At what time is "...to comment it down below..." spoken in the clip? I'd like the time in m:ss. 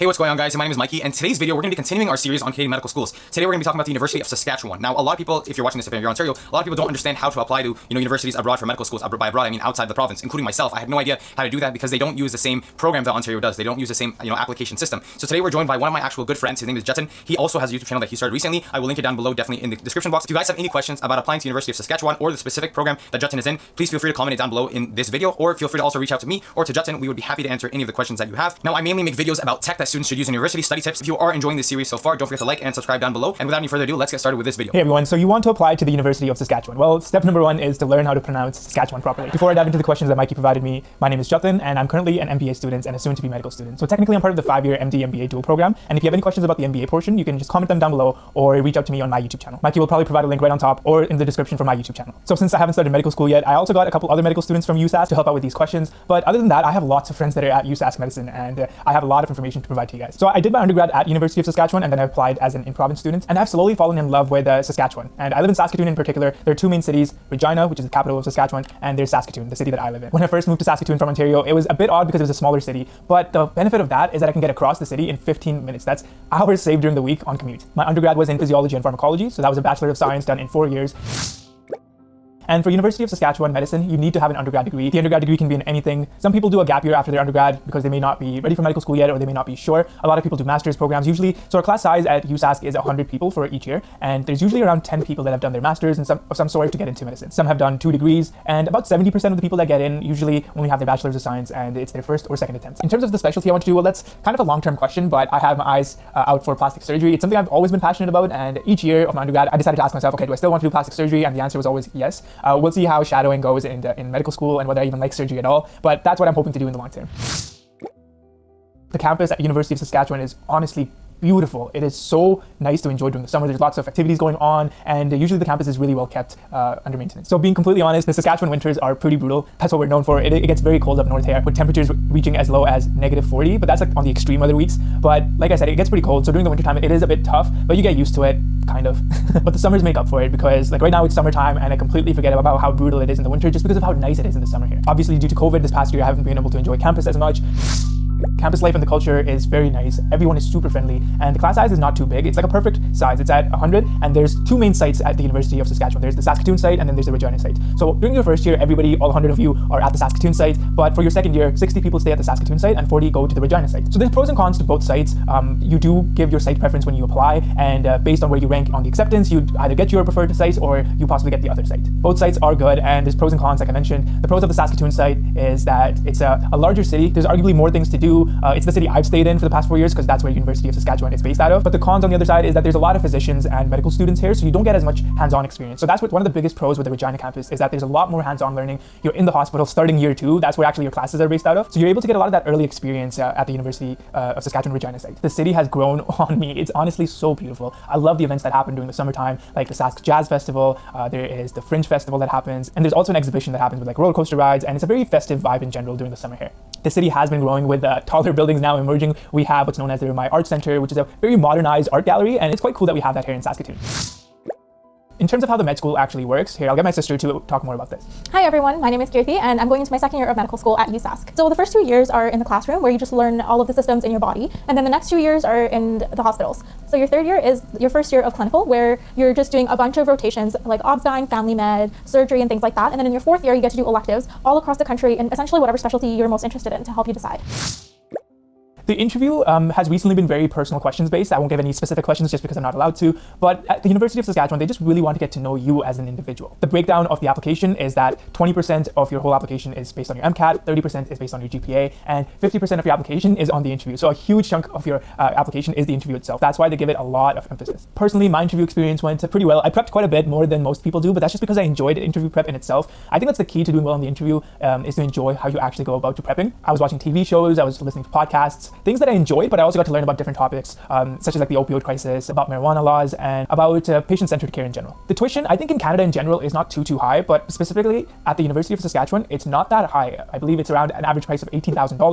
0:24.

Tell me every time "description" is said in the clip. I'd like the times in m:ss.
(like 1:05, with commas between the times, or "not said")
0:19, 0:51.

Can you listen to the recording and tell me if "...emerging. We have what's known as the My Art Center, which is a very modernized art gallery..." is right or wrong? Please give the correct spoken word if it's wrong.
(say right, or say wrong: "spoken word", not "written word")
right.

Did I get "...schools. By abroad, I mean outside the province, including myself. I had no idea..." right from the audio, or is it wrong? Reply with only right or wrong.
right.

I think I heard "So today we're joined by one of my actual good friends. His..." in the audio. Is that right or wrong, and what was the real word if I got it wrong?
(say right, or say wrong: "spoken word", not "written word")
right.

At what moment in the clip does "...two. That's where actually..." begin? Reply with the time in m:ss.
3:10.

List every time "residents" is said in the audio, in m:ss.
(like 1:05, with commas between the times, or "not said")
not said.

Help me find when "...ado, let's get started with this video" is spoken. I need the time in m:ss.
0:33.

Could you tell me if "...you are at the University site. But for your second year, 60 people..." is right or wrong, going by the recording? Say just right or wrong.
wrong.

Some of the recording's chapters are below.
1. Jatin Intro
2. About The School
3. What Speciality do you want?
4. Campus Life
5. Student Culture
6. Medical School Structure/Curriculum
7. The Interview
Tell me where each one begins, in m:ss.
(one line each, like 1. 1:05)
1. 0:34
2. 1:20
3. 1:41
4. 1:56
5. 2:26
6. 3:32
7. 3:56.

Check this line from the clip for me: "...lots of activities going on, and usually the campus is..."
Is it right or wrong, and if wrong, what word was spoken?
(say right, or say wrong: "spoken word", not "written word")
right.